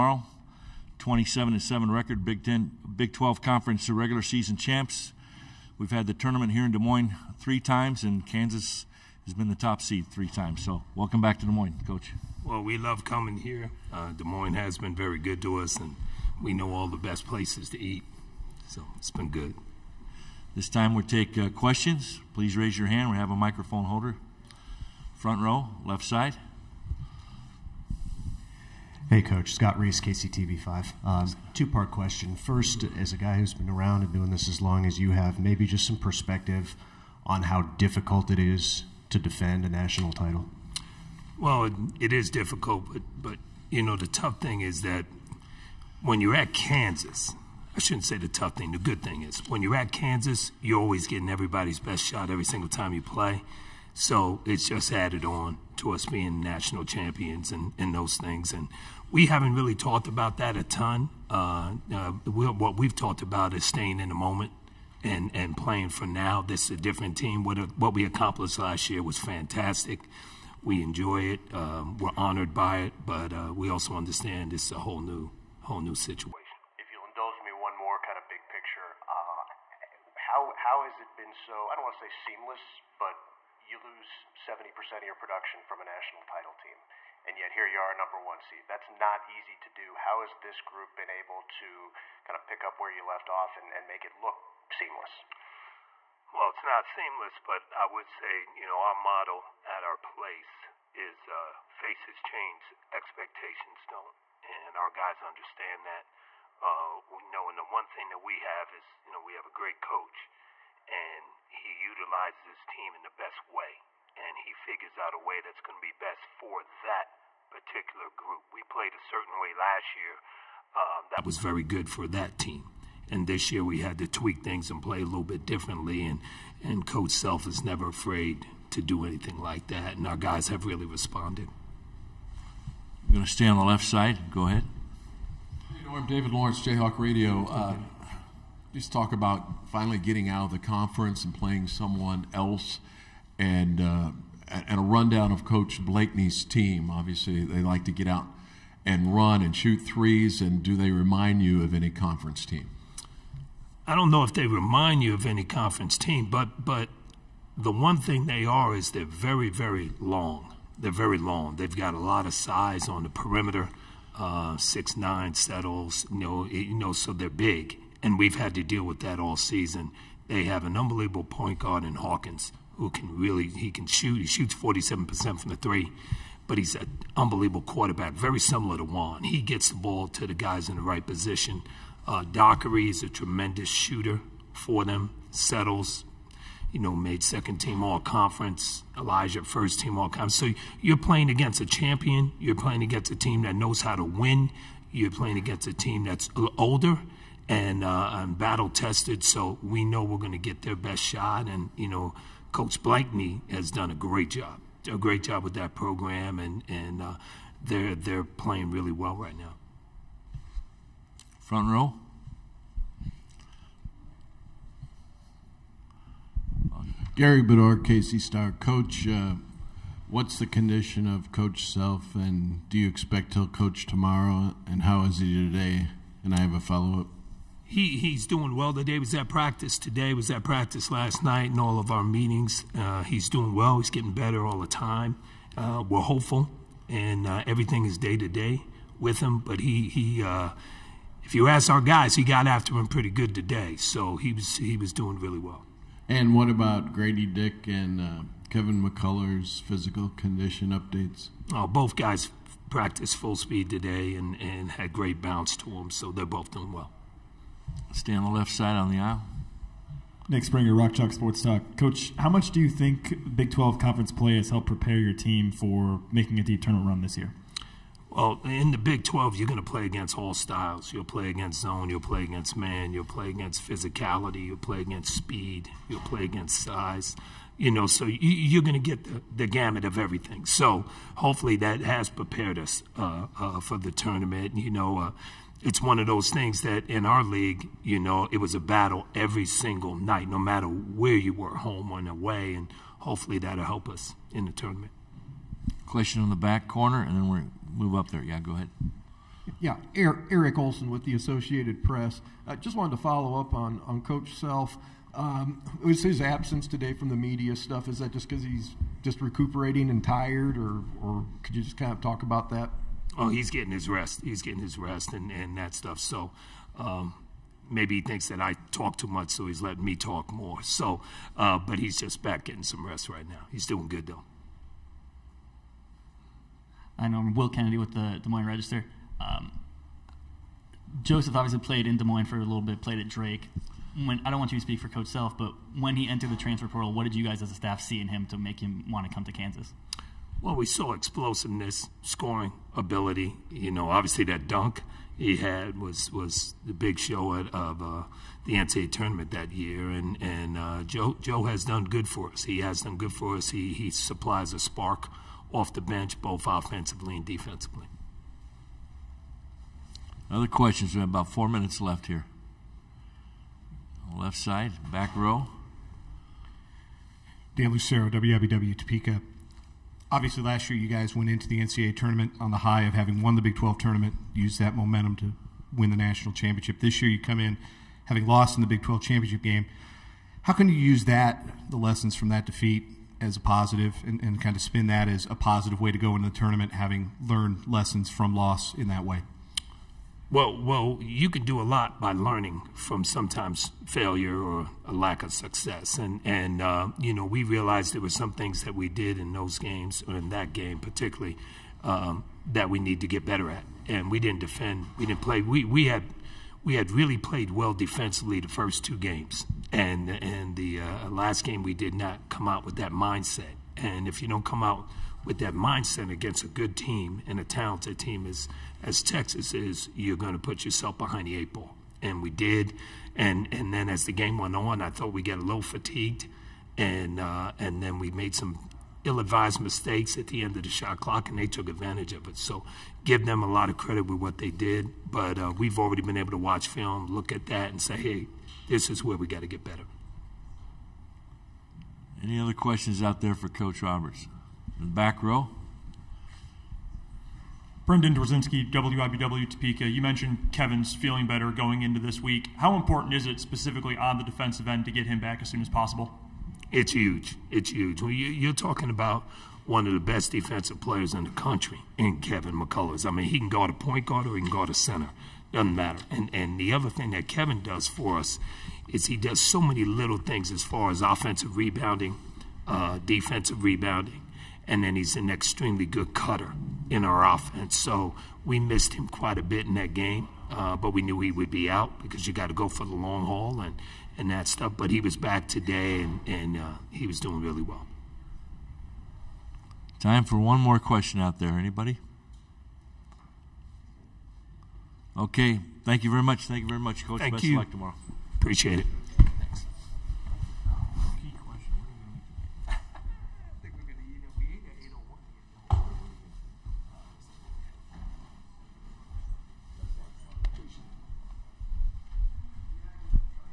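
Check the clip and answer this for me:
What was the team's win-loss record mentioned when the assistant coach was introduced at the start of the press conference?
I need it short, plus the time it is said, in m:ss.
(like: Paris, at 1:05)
27-7, at 0:00.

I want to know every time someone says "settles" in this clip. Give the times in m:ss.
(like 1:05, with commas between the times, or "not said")
2:45, 3:05.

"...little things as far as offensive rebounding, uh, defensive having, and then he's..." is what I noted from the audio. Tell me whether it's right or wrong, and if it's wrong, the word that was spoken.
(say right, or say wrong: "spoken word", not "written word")
wrong: "rebounding", not "having".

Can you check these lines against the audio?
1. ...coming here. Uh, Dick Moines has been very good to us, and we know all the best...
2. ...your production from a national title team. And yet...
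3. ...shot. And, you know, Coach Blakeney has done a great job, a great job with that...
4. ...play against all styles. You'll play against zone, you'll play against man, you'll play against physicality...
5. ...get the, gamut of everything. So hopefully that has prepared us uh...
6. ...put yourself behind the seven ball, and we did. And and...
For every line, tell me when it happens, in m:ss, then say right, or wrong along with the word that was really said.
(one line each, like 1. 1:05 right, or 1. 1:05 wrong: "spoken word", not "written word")
1. 0:13 wrong: "Des", not "Dick"
2. 1:25 right
3. 3:21 right
4. 4:29 right
5. 4:38 right
6. 7:00 wrong: "eight", not "seven".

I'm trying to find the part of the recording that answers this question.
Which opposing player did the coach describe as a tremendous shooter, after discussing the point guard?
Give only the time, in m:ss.
3:02.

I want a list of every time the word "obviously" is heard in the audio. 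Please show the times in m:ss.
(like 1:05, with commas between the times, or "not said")
2:26, 5:31, 5:43, 6:10.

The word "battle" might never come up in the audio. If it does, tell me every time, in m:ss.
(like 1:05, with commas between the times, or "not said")
3:18, 4:48.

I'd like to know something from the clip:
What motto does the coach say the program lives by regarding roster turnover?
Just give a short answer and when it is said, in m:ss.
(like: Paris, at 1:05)
Faces change, expectations don't, at 1:41.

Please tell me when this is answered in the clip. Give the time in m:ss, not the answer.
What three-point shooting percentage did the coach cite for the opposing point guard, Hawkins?
2:54.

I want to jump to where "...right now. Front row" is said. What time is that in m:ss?
3:29.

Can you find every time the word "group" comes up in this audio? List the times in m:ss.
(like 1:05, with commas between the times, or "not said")
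1:30, 1:58.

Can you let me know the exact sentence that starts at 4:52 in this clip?
And hopefully that'll help us in the tournament.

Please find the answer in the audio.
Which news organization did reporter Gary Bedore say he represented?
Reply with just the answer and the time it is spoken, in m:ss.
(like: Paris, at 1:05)
KC Star, at 3:37.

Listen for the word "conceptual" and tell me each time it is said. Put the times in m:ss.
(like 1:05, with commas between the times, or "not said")
not said.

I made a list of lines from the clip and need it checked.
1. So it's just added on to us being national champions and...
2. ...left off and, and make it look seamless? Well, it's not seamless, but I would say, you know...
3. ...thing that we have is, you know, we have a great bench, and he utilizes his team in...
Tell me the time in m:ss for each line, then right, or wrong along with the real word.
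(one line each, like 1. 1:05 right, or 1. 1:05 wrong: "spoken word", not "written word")
1. 0:53 right
2. 1:33 right
3. 1:47 wrong: "coach", not "bench".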